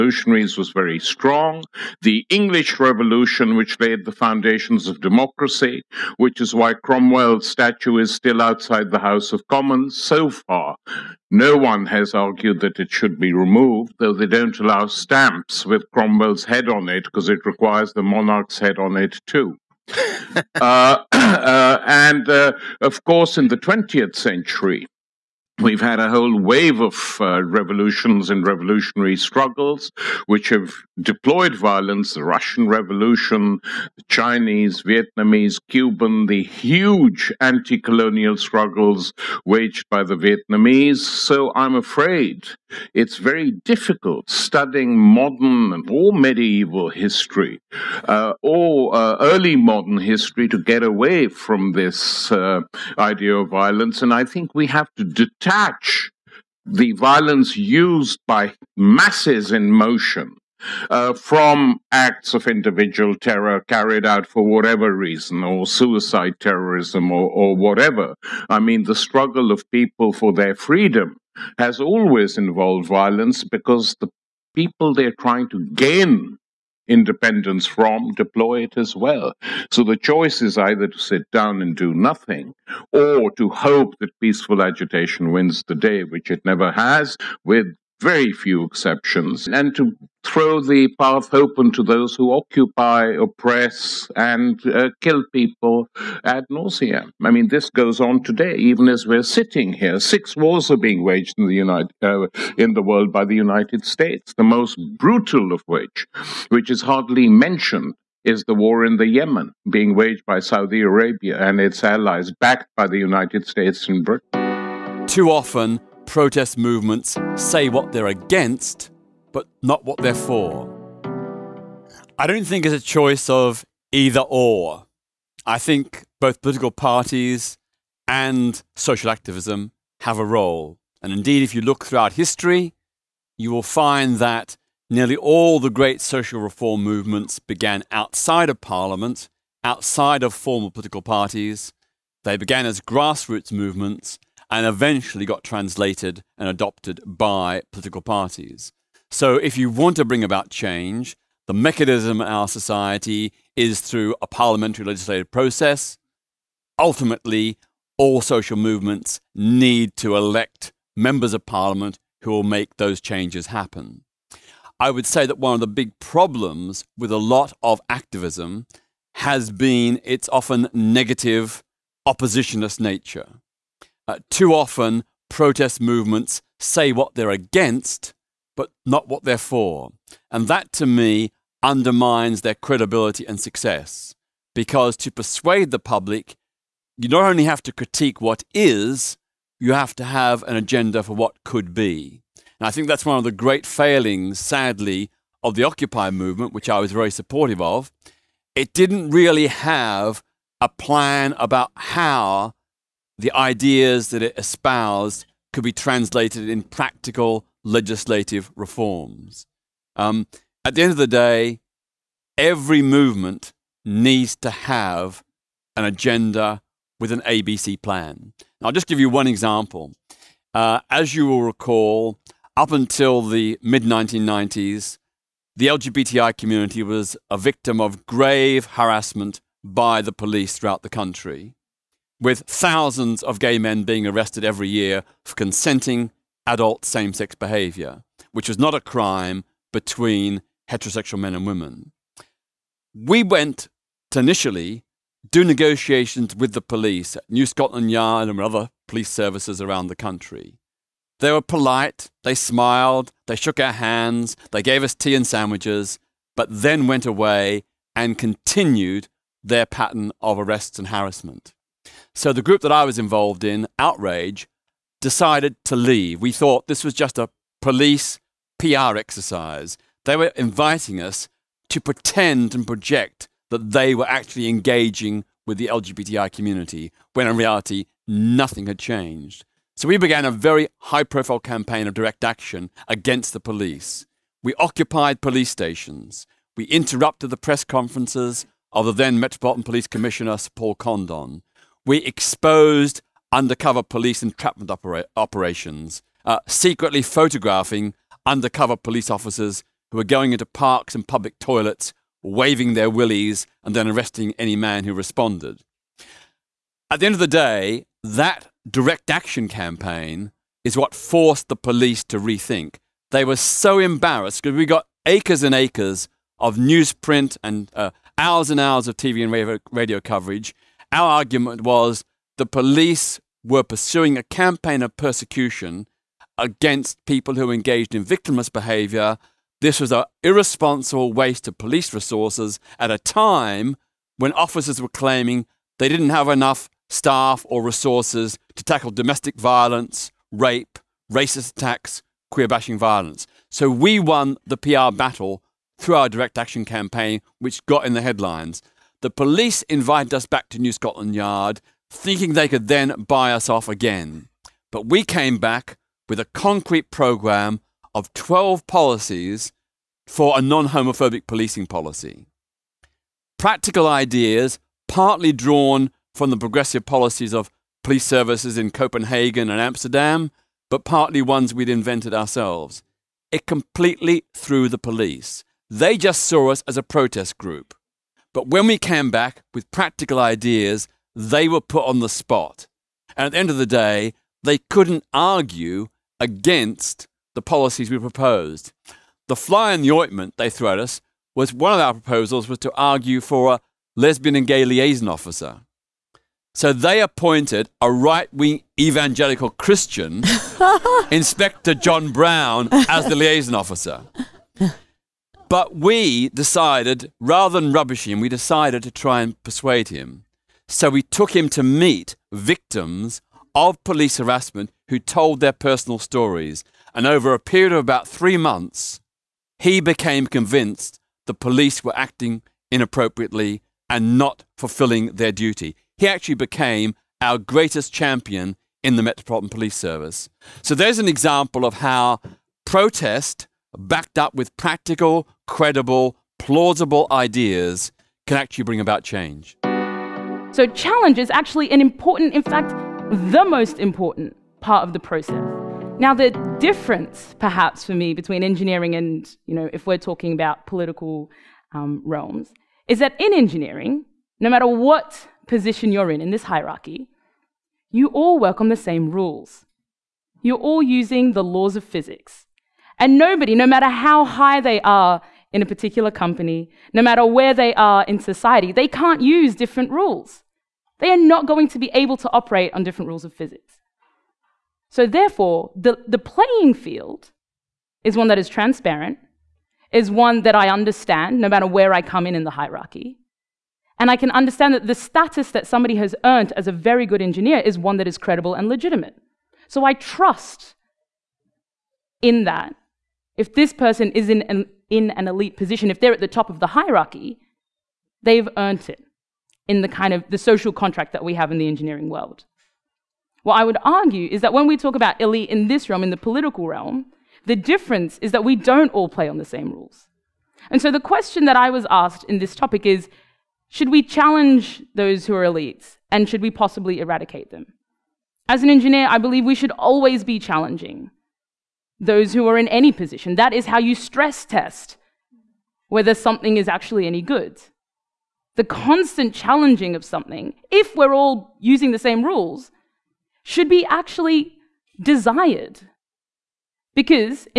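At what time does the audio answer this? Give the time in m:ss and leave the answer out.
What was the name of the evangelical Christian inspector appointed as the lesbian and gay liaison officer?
6:41.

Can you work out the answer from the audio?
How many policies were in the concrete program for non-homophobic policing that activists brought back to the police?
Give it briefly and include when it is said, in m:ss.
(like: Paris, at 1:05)
12, at 5:58.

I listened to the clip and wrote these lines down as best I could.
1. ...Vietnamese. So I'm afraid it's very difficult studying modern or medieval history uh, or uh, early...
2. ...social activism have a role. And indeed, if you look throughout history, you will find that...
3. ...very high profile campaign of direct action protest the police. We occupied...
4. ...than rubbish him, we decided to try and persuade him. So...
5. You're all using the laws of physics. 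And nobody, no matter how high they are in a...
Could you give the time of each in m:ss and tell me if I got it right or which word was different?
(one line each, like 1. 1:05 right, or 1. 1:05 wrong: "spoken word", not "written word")
1. 0:40 right
2. 2:08 right
3. 4:40 wrong: "against", not "protest"
4. 6:47 right
5. 7:40 right.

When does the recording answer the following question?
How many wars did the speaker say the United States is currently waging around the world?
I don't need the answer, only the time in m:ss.
1:39.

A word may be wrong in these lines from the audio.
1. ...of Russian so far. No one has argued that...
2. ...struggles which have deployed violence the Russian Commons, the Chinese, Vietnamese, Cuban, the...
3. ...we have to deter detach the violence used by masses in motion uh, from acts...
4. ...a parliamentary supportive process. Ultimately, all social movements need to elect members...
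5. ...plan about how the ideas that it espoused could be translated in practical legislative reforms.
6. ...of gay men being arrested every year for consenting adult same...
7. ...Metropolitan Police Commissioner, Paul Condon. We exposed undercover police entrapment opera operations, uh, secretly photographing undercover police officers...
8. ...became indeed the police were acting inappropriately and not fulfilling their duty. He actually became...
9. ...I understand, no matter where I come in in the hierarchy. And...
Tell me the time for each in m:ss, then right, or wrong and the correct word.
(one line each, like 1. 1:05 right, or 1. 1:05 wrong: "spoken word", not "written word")
1. 0:09 wrong: "Commons", not "Russian"
2. 0:29 wrong: "Revolution", not "Commons"
3. 0:54 right
4. 2:34 wrong: "legislative", not "supportive"
5. 3:20 right
6. 3:53 right
7. 4:49 right
8. 6:59 wrong: "convinced", not "indeed"
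9. 8:00 right.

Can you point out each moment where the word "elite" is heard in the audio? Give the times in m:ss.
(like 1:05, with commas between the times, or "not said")
8:15, 8:25, 8:35.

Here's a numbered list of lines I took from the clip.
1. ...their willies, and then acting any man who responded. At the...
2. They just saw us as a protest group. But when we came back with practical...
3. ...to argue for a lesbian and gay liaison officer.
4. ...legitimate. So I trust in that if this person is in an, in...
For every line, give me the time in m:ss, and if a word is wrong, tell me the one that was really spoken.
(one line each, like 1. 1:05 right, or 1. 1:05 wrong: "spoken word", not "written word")
1. 5:02 wrong: "arresting", not "acting"
2. 6:15 right
3. 6:32 right
4. 8:08 right.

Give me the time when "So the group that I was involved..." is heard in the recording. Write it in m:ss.
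4:22.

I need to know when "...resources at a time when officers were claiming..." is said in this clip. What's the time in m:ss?
5:31.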